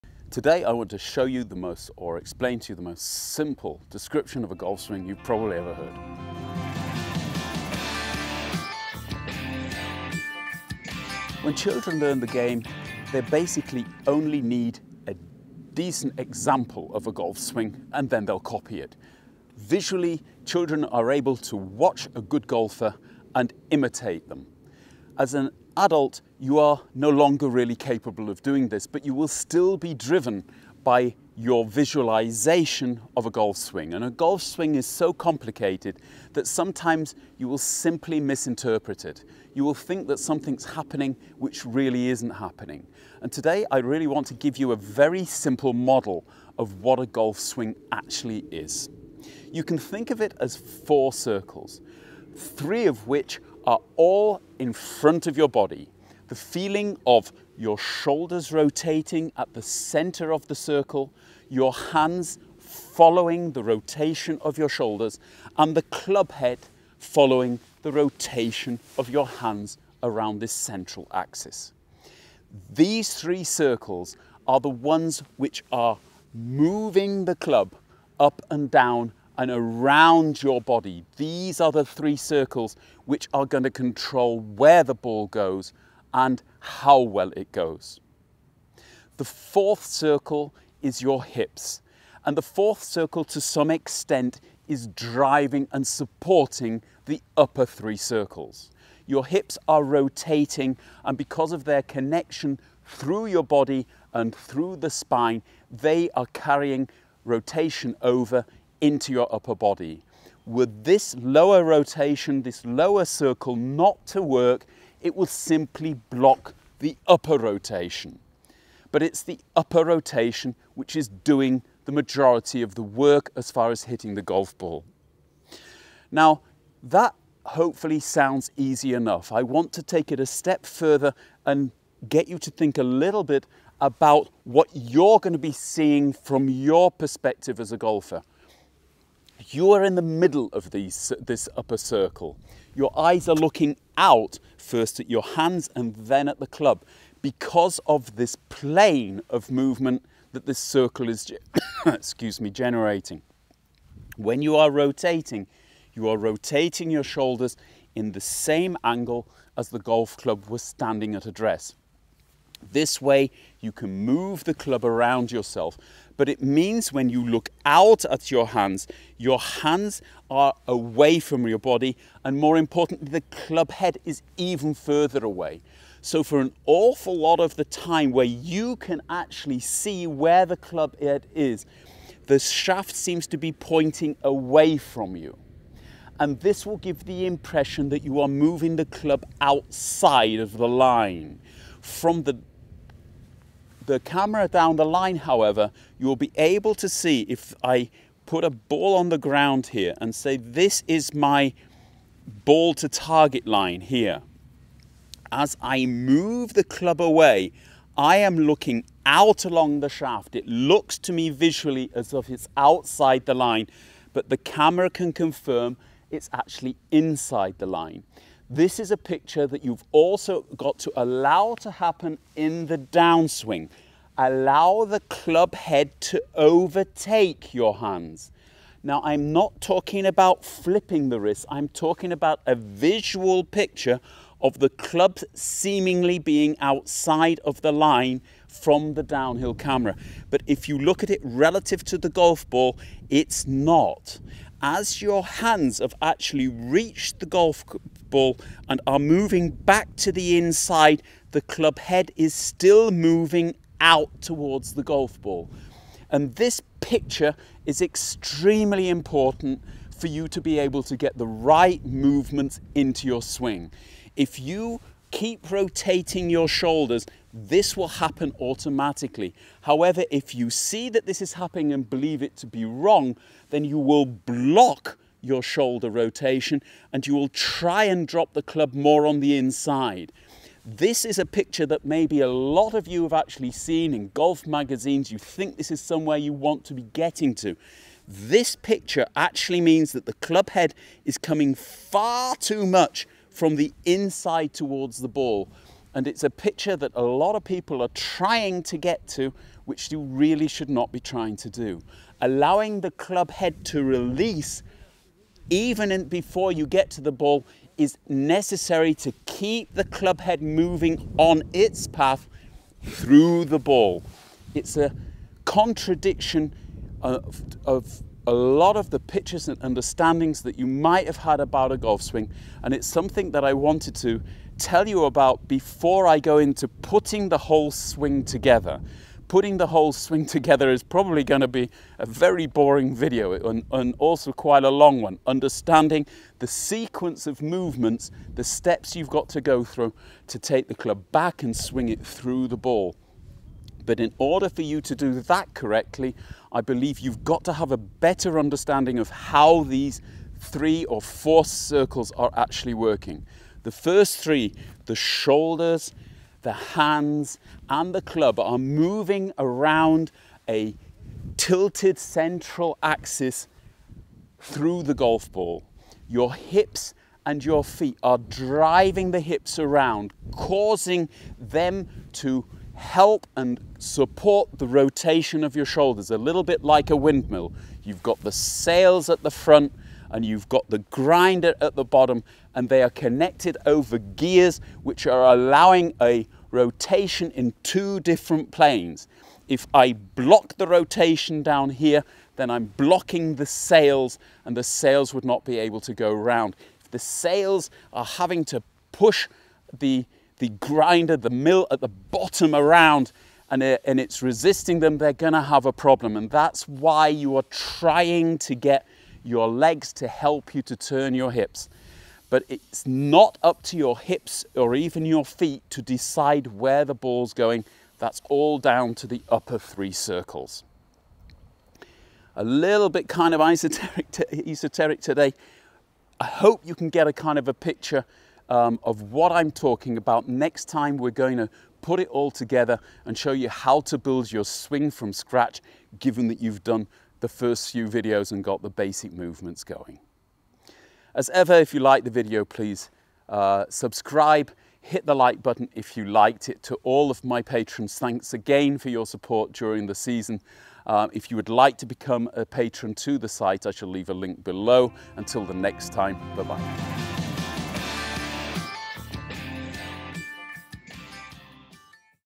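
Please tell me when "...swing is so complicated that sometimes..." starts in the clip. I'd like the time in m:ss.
0:34.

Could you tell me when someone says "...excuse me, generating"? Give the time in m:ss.
2:31.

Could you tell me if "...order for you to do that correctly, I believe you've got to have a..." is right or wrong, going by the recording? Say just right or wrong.
right.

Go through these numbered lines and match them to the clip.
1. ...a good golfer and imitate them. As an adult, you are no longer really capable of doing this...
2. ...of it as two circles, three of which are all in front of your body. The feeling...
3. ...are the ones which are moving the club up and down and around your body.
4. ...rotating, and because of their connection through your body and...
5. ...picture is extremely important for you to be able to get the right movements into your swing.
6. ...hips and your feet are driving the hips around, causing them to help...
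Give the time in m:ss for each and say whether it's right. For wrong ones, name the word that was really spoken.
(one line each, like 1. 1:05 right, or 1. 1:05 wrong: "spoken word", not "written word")
1. 0:22 right
2. 0:50 wrong: "four", not "two"
3. 1:14 right
4. 1:39 right
5. 4:16 right
6. 6:06 right.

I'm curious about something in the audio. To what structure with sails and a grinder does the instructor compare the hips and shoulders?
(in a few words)
A windmill.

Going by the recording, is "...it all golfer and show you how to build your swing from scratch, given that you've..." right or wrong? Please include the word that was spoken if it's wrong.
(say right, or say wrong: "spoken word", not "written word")
wrong: "together", not "golfer".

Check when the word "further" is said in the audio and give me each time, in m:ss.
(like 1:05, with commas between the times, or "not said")
2:10, 2:54.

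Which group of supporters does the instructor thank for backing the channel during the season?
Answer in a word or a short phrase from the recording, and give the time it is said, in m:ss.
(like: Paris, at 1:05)
Patrons, at 7:27.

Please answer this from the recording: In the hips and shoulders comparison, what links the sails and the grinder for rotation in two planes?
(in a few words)
Gears.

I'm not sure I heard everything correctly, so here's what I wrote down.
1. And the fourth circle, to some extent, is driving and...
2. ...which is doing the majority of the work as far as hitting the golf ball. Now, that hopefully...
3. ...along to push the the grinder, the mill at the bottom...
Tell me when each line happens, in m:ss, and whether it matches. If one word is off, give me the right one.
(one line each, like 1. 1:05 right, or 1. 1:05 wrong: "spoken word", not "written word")
1. 1:32 right
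2. 2:00 right
3. 6:38 wrong: "having", not "along".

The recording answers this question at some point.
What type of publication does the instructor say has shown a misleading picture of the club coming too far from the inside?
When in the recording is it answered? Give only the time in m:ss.
4:44.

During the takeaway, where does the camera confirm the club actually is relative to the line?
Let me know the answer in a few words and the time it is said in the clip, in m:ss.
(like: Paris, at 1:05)
Inside the line, at 3:36.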